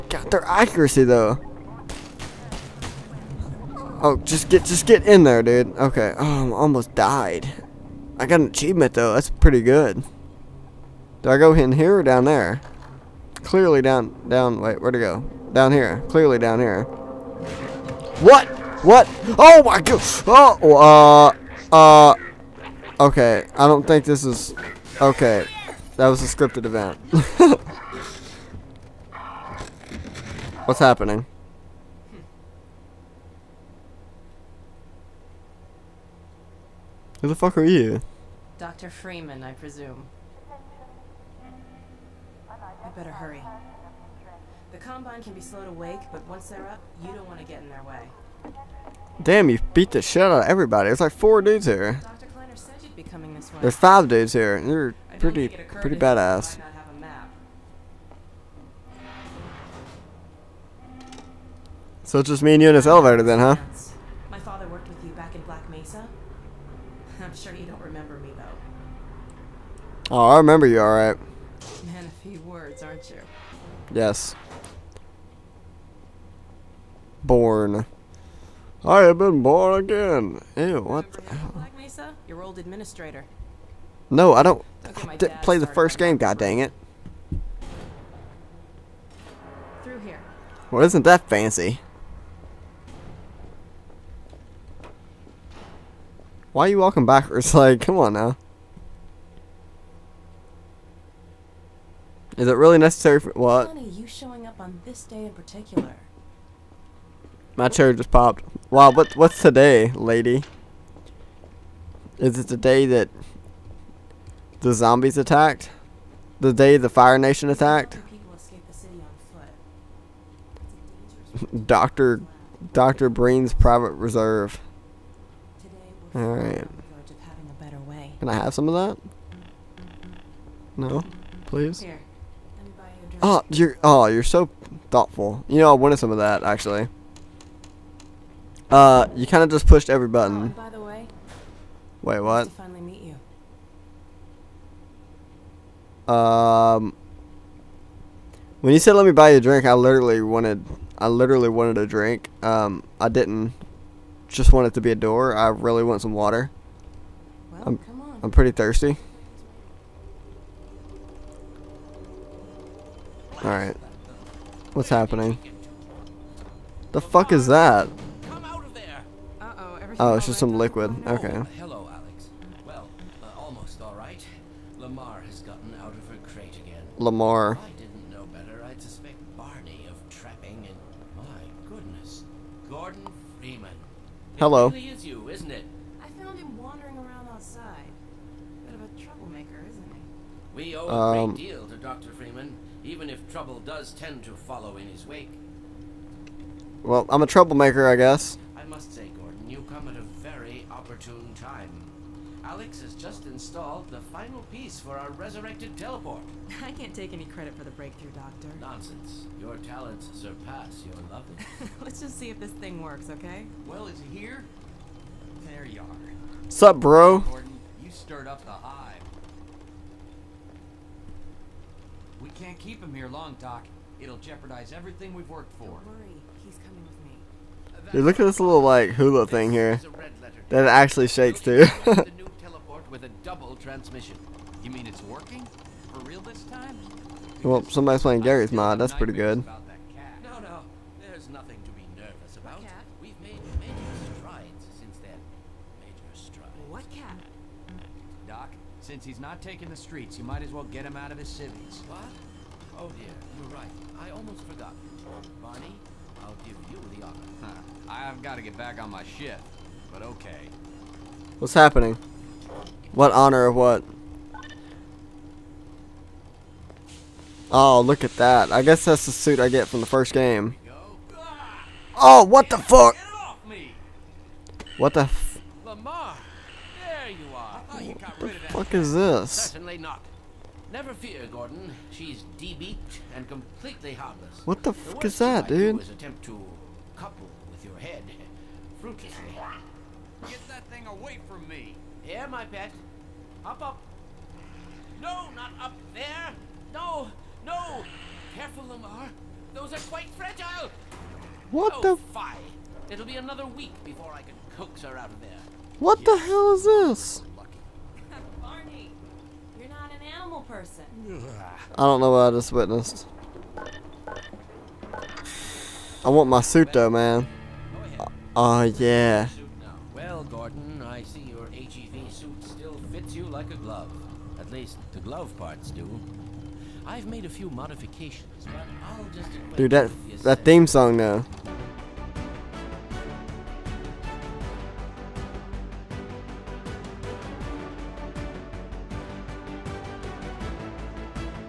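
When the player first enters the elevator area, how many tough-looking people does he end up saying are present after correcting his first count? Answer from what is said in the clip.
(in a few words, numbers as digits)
5.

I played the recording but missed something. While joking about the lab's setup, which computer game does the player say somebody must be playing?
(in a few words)
Garry's Mod.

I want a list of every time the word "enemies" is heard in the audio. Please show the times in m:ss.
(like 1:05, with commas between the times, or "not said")
not said.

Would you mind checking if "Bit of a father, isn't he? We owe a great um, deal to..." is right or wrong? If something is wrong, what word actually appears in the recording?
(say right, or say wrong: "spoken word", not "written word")
wrong: "troublemaker", not "father".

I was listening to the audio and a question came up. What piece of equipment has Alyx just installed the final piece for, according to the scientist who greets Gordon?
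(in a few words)
resurrected teleport.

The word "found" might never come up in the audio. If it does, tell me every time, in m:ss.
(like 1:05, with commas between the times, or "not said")
3:06.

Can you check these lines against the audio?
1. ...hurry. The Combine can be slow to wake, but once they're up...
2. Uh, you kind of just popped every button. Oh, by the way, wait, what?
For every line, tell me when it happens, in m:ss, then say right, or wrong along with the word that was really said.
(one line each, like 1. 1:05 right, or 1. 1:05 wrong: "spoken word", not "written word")
1. 0:43 right
2. 2:18 wrong: "pushed", not "popped".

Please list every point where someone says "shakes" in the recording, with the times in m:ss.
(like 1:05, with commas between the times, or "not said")
3:51.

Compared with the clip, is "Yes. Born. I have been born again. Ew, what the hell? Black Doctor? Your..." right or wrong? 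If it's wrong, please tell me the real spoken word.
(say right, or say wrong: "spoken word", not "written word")
wrong: "Mesa", not "Doctor".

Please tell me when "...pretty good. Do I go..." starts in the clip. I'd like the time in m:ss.
0:09.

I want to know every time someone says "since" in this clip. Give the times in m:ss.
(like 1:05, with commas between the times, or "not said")
4:04, 4:08.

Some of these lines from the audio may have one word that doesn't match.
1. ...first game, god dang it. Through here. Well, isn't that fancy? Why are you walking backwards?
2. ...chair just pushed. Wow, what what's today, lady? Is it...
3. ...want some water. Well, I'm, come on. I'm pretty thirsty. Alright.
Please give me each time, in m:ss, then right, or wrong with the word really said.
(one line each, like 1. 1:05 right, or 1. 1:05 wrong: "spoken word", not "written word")
1. 1:25 right
2. 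1:47 wrong: "popped", not "pushed"
3. 2:35 right.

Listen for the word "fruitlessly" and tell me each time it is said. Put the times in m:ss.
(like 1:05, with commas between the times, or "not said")
4:48.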